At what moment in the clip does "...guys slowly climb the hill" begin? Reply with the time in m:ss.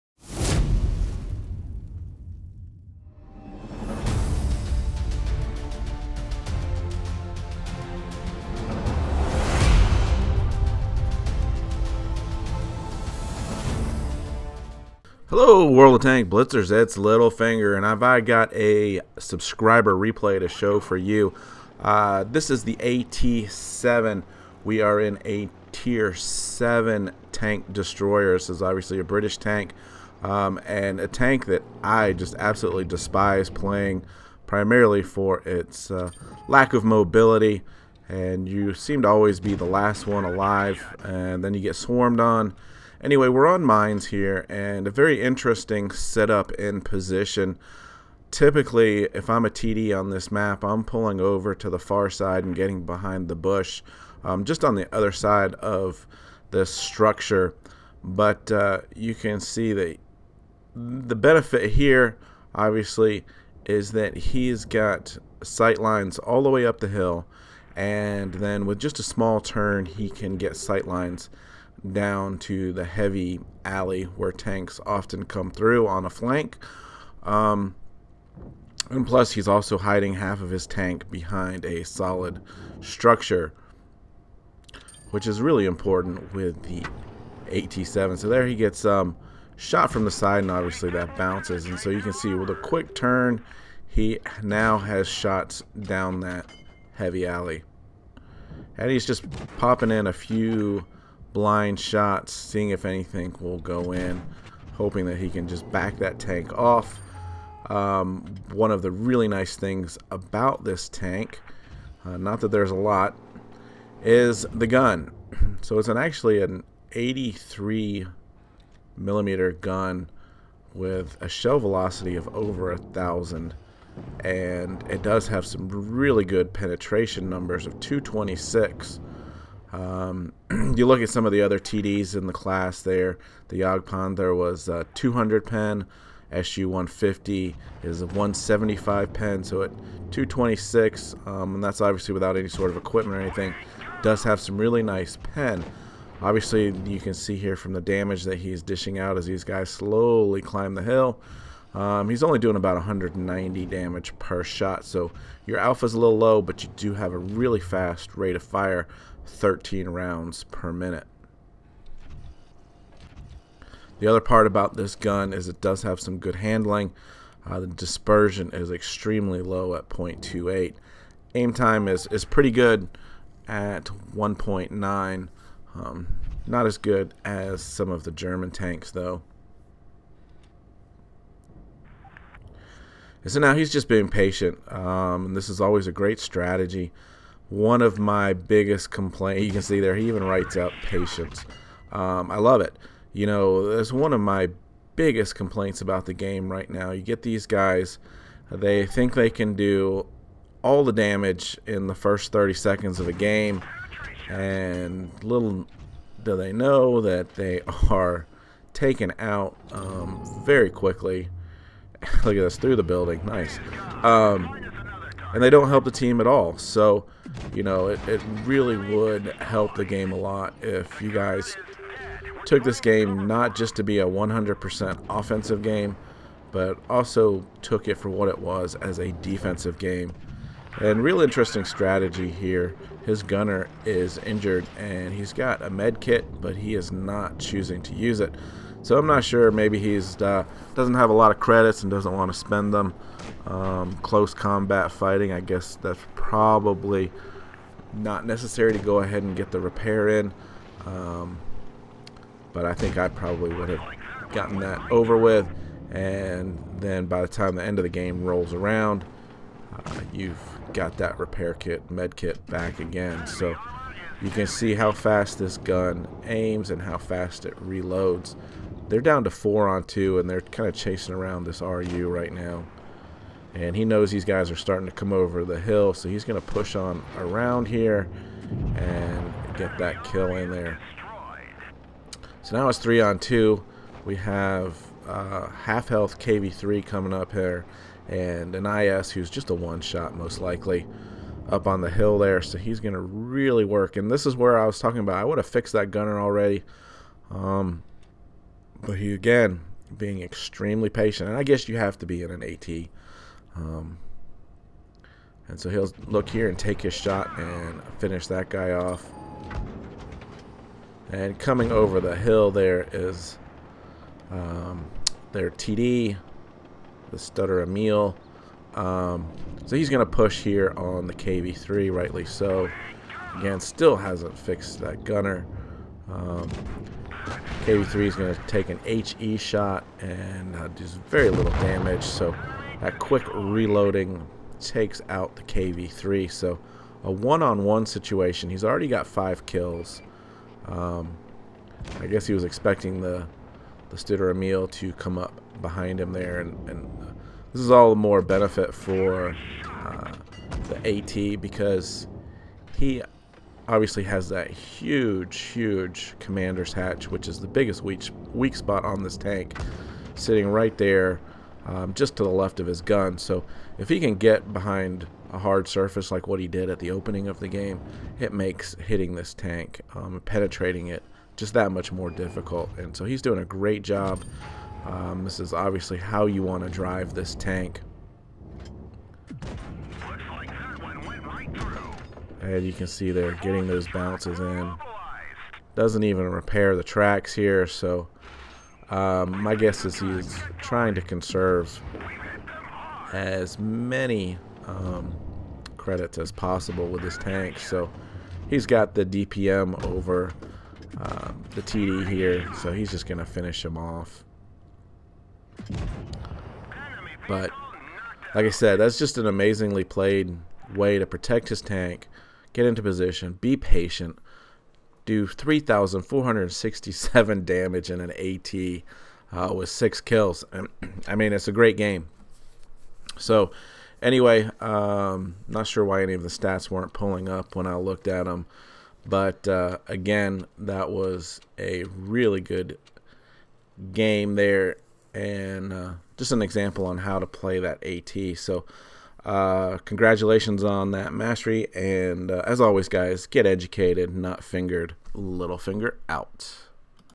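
2:29.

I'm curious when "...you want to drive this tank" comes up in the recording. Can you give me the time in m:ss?
6:16.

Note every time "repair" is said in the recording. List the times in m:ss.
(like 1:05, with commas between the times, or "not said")
4:09, 4:21, 6:26.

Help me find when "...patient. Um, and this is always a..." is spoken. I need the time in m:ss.
3:04.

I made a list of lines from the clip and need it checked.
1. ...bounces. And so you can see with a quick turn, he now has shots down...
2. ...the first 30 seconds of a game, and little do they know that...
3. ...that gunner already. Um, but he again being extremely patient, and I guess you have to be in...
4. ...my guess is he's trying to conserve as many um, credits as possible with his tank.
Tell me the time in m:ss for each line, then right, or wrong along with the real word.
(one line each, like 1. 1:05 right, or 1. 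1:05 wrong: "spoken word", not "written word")
1. 1:31 right
2. 3:21 right
3. 4:55 right
4. 6:29 right.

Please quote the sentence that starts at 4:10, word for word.
Um, but I think I probably would have gotten that over with.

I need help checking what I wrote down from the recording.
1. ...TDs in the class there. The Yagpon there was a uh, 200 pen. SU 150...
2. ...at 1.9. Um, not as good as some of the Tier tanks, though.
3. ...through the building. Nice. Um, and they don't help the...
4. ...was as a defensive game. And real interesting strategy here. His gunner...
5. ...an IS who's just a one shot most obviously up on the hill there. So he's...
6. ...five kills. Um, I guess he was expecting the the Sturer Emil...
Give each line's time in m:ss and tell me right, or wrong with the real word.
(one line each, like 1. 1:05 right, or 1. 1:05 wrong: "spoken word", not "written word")
1. 2:11 right
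2. 2:53 wrong: "German", not "Tier"
3. 3:32 right
4. 3:48 right
5. 4:48 wrong: "likely", not "obviously"
6. 5:39 right.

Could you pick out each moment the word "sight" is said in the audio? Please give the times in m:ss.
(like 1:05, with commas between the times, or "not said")
1:05, 1:10.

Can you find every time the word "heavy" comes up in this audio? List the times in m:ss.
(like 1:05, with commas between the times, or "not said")
1:12, 1:36.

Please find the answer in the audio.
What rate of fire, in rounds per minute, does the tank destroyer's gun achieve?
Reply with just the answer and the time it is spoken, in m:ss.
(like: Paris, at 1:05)
13 rounds per minute, at 2:39.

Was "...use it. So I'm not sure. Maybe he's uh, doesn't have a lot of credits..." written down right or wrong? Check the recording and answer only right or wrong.
right.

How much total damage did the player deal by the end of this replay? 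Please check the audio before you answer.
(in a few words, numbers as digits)
3,467.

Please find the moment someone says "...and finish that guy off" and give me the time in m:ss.
5:07.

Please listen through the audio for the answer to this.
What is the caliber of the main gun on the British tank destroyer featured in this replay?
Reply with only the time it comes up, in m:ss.
1:56.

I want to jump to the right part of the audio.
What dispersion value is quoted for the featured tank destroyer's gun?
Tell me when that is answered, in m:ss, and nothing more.
2:49.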